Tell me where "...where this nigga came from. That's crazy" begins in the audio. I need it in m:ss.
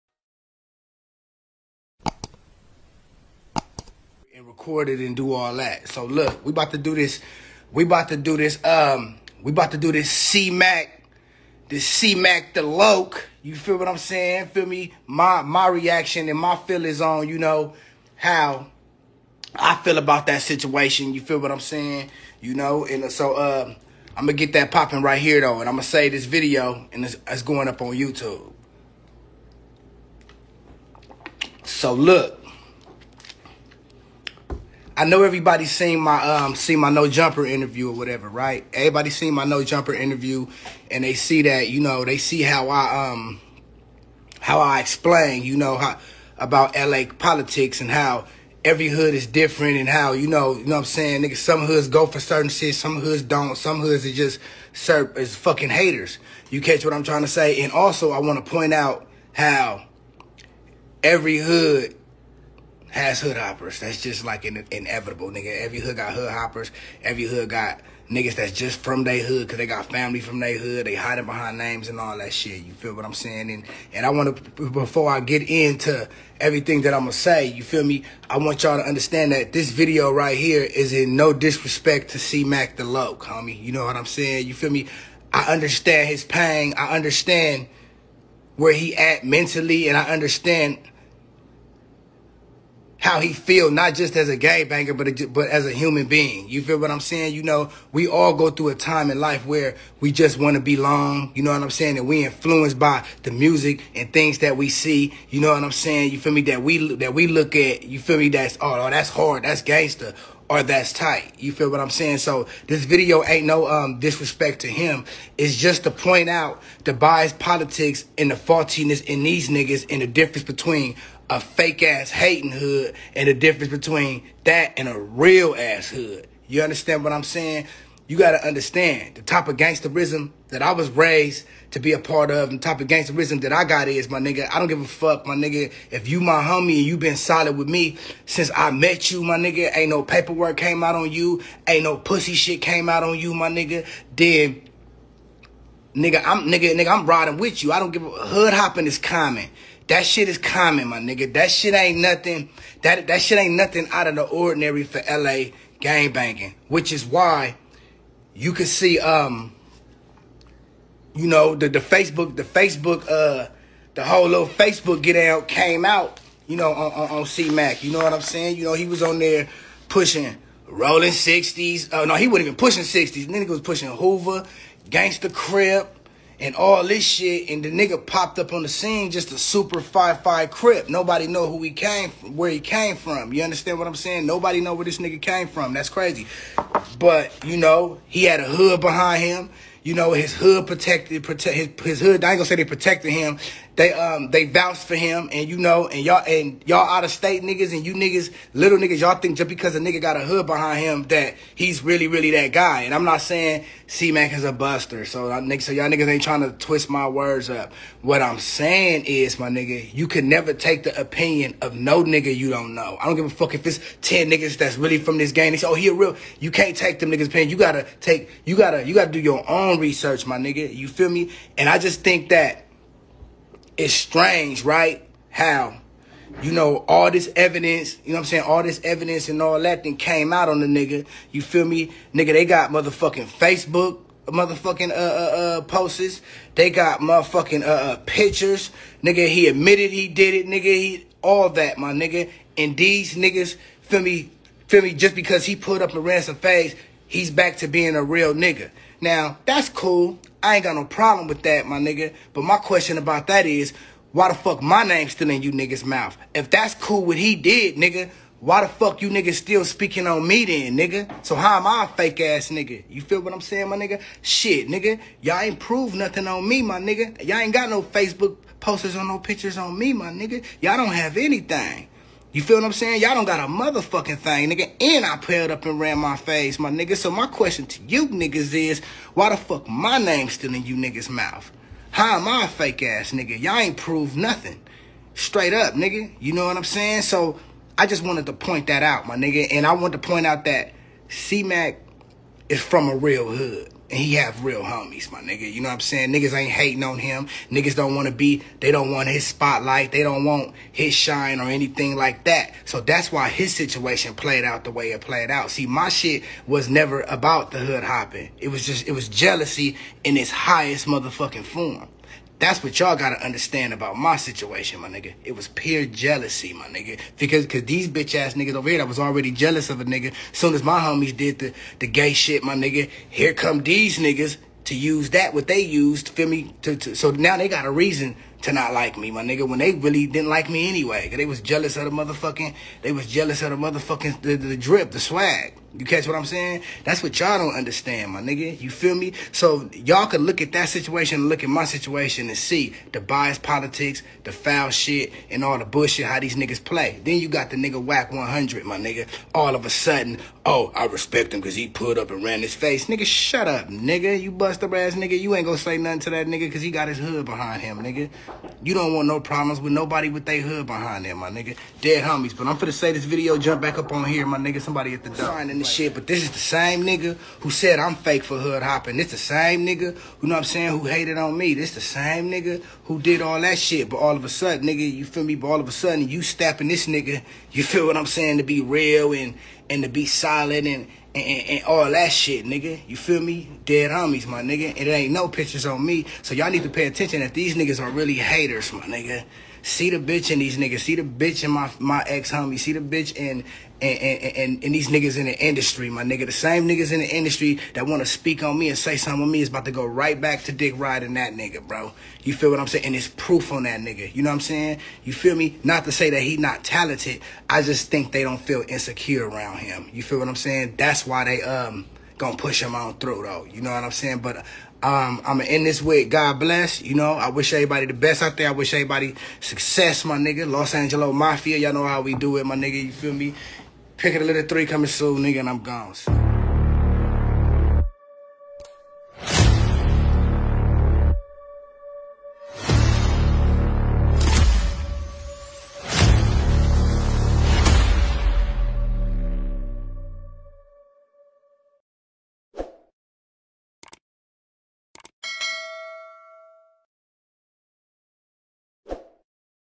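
3:04.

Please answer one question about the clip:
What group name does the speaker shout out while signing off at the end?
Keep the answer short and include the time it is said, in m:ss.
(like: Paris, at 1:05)
Los Angeles Mafia, at 7:00.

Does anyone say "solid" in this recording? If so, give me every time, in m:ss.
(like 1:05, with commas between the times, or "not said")
2:17, 6:20.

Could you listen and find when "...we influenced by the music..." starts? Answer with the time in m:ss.
1:42.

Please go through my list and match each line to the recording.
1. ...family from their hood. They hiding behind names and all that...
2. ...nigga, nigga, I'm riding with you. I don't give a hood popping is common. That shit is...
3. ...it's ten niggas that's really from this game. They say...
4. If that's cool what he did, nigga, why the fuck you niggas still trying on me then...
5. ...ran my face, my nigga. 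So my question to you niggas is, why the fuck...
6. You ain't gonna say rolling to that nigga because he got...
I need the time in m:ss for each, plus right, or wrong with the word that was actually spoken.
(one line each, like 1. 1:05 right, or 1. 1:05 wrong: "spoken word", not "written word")
1. 1:09 right
2. 2:26 wrong: "hopping", not "popping"
3. 3:33 right
4. 4:16 wrong: "speaking", not "trying"
5. 4:35 right
6. 5:55 wrong: "nothing", not "rolling".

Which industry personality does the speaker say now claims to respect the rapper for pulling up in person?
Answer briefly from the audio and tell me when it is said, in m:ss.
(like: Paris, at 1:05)
Wack 100, at 5:47.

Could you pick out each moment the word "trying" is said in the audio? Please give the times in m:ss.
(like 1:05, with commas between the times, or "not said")
0:57, 3:26.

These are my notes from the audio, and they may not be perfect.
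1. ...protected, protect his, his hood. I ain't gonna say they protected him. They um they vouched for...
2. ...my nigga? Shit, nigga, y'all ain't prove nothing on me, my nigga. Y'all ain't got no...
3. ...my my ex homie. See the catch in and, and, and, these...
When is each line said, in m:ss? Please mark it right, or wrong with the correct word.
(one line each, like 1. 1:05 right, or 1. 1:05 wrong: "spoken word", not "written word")
1. 3:10 right
2. 4:23 right
3. 6:31 wrong: "bitch", not "catch".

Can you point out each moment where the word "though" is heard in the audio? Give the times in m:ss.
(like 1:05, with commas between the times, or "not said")
0:25, 6:53.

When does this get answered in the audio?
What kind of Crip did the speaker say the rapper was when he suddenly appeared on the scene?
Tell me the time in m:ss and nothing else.
2:59.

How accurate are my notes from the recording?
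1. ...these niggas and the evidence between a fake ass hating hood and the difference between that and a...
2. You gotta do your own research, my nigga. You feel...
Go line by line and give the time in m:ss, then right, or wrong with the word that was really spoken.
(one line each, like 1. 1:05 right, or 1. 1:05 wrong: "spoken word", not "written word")
1. 1:59 wrong: "difference", not "evidence"
2. 3:38 right.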